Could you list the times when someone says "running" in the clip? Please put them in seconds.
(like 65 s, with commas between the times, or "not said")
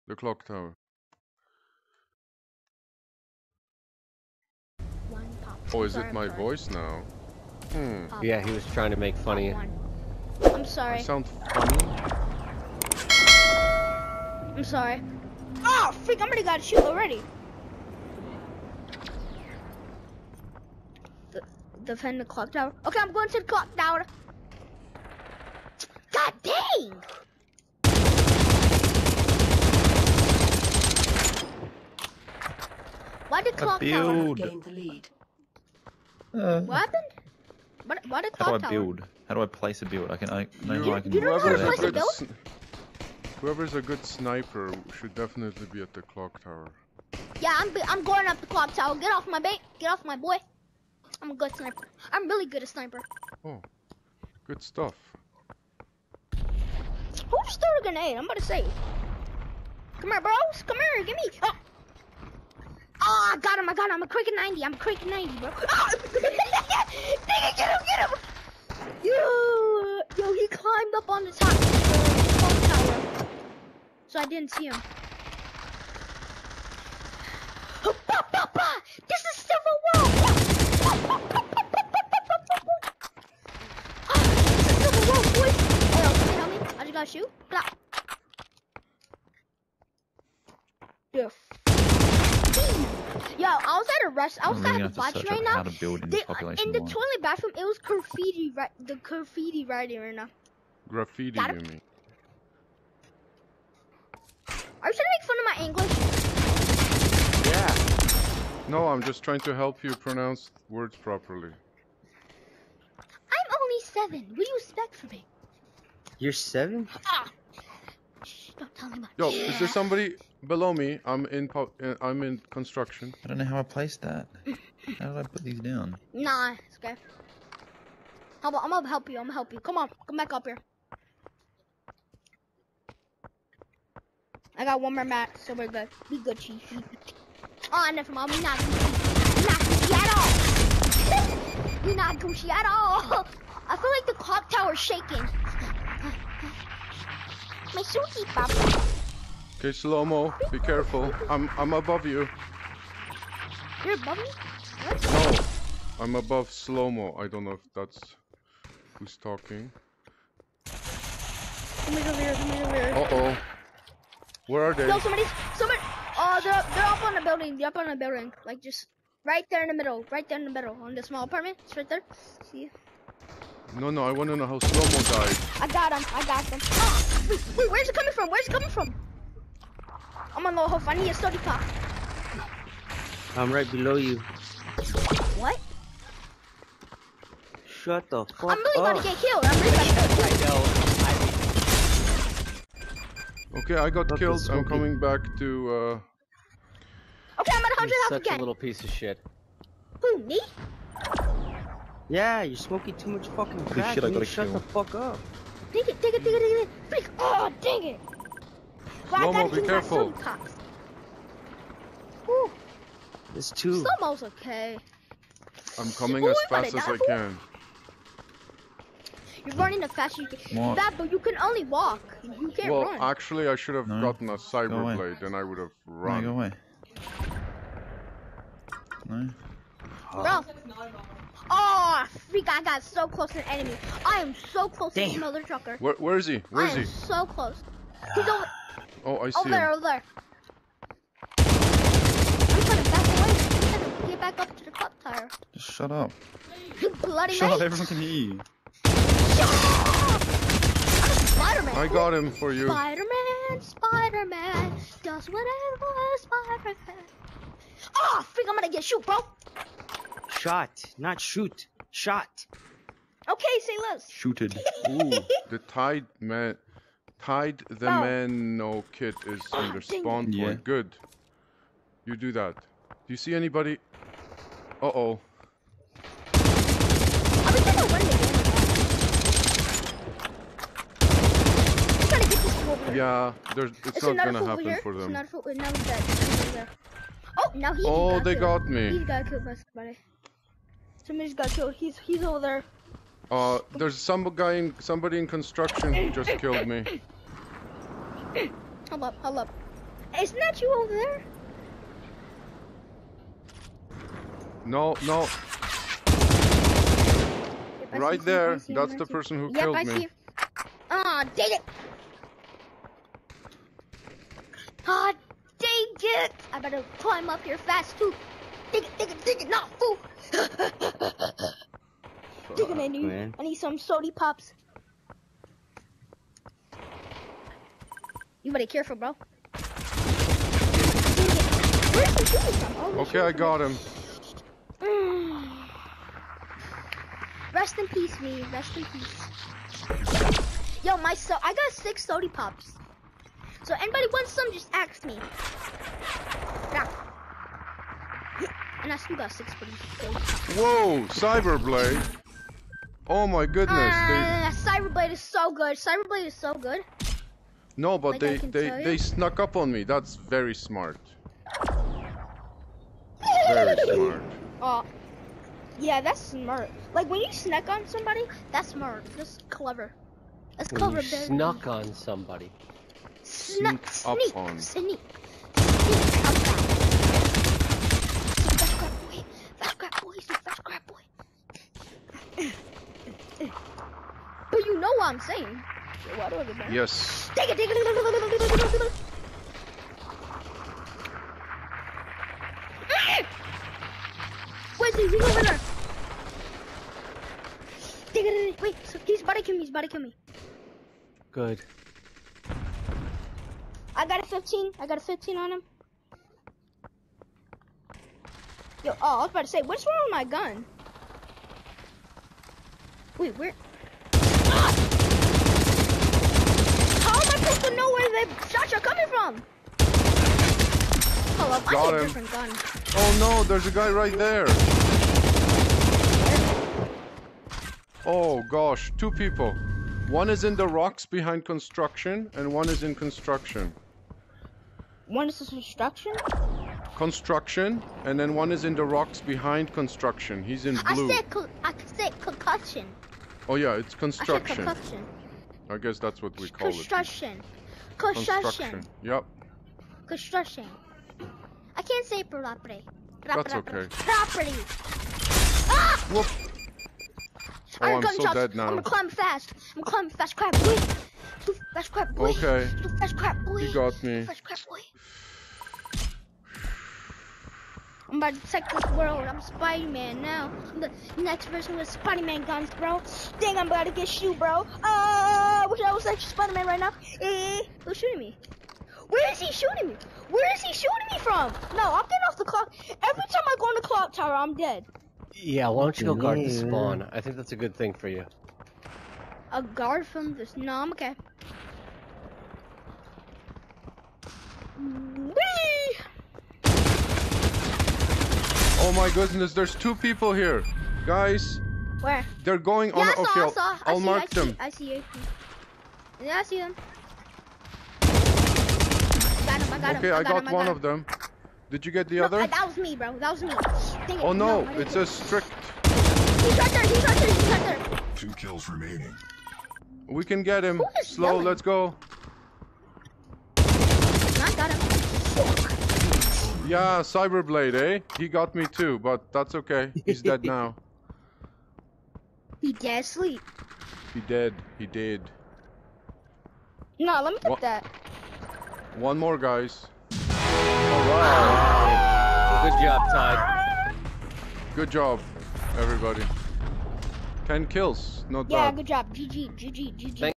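219 s.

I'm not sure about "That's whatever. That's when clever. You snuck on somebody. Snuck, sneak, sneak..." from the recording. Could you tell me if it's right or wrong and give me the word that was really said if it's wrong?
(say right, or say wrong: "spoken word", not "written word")
wrong: "clever", not "whatever".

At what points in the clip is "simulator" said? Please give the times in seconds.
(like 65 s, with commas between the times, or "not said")
not said.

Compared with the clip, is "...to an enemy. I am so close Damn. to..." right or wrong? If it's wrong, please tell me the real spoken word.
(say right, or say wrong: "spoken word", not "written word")
right.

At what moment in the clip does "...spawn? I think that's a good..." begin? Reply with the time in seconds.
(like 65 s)
486 s.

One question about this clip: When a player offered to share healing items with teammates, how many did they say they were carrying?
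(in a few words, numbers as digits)
6.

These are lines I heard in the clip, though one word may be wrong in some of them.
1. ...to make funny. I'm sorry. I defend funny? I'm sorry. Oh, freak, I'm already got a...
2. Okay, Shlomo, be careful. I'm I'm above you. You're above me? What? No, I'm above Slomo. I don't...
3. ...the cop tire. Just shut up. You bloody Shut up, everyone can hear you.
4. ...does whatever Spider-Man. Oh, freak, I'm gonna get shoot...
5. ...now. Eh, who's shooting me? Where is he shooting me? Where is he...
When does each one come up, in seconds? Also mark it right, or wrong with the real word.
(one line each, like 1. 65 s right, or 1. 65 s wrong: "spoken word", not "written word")
1. 8 s wrong: "sound", not "defend"
2. 149 s right
3. 244 s right
4. 255 s right
5. 476 s right.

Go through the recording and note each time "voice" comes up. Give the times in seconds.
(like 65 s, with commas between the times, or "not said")
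6 s.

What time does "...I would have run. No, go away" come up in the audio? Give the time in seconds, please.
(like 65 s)
225 s.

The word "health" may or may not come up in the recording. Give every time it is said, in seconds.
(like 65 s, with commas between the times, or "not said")
180 s, 197 s.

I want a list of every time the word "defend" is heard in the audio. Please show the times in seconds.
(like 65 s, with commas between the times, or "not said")
21 s.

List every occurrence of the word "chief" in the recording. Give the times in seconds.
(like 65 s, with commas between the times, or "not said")
136 s.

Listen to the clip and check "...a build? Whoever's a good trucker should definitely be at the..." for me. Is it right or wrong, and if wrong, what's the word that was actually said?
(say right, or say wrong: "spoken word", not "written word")
wrong: "sniper", not "trucker".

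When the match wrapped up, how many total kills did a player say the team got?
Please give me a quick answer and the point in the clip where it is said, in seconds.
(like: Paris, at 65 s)
10, at 547 s.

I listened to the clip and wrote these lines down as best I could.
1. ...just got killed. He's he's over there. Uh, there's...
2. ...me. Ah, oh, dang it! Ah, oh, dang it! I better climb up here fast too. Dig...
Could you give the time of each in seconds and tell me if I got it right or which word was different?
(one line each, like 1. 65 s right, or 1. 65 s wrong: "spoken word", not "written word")
1. 291 s right
2. 309 s right.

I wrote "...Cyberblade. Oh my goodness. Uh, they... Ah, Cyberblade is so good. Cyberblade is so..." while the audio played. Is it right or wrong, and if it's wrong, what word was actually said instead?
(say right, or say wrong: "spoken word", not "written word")
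right.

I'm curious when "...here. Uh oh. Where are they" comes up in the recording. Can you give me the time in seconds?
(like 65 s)
162 s.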